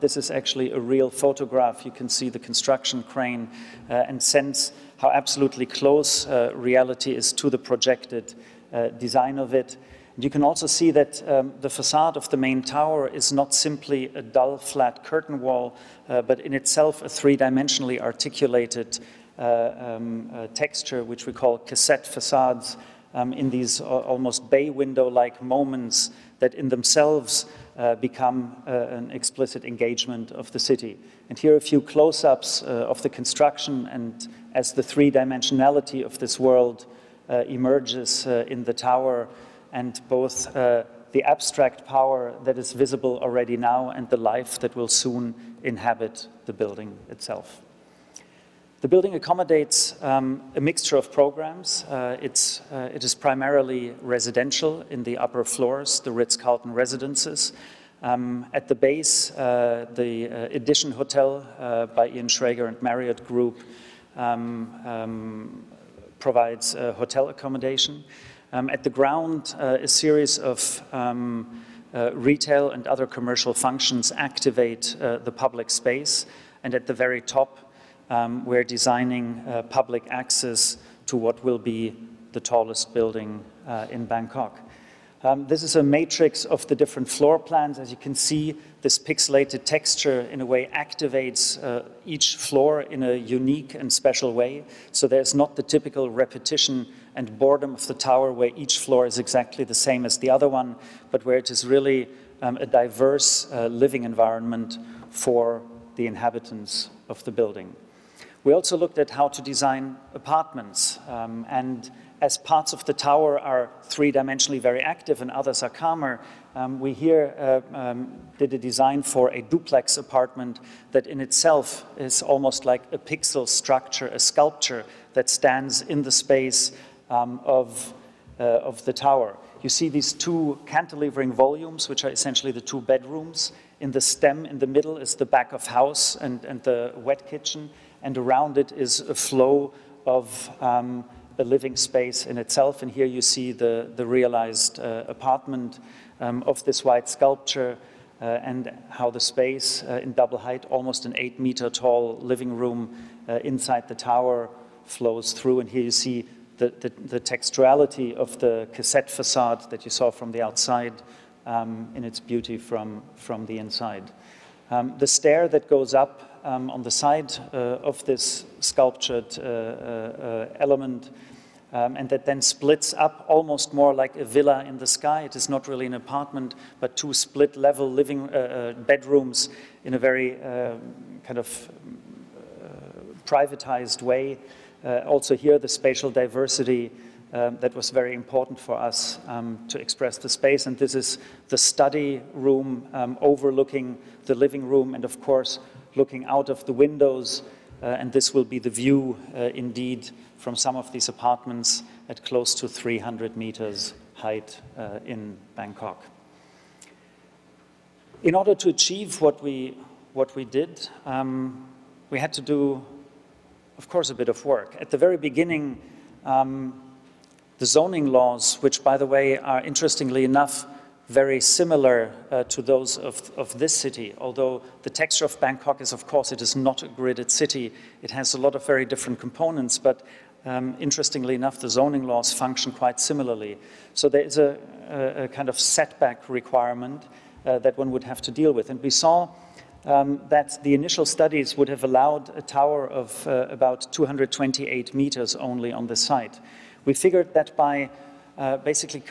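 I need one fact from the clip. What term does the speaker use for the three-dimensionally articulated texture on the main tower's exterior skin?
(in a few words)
Cassette facades.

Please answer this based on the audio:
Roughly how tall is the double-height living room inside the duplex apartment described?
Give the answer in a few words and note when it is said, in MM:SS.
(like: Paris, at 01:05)
8 meters, at 02:31.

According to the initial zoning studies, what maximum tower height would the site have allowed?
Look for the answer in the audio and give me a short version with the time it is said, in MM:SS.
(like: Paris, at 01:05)
228 meters, at 04:03.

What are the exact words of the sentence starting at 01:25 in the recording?
Um, this is a matrix of the different floor plans.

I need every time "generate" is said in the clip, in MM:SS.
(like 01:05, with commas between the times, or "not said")
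not said.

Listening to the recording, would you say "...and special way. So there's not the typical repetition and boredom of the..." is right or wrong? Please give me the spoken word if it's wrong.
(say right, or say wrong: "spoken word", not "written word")
right.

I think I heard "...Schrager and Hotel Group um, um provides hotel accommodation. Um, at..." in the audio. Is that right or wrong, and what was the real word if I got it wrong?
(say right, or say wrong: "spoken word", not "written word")
wrong: "Marriott", not "Hotel".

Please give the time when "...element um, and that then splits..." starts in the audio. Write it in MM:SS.
02:50.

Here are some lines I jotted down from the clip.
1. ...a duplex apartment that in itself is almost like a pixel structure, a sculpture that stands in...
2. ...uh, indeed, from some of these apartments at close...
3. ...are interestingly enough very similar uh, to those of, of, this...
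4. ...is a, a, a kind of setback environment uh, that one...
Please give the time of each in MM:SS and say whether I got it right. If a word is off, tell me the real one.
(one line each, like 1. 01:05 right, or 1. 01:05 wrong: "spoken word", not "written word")
1. 01:59 right
2. 03:19 right
3. 03:39 right
4. 03:54 wrong: "requirement", not "environment".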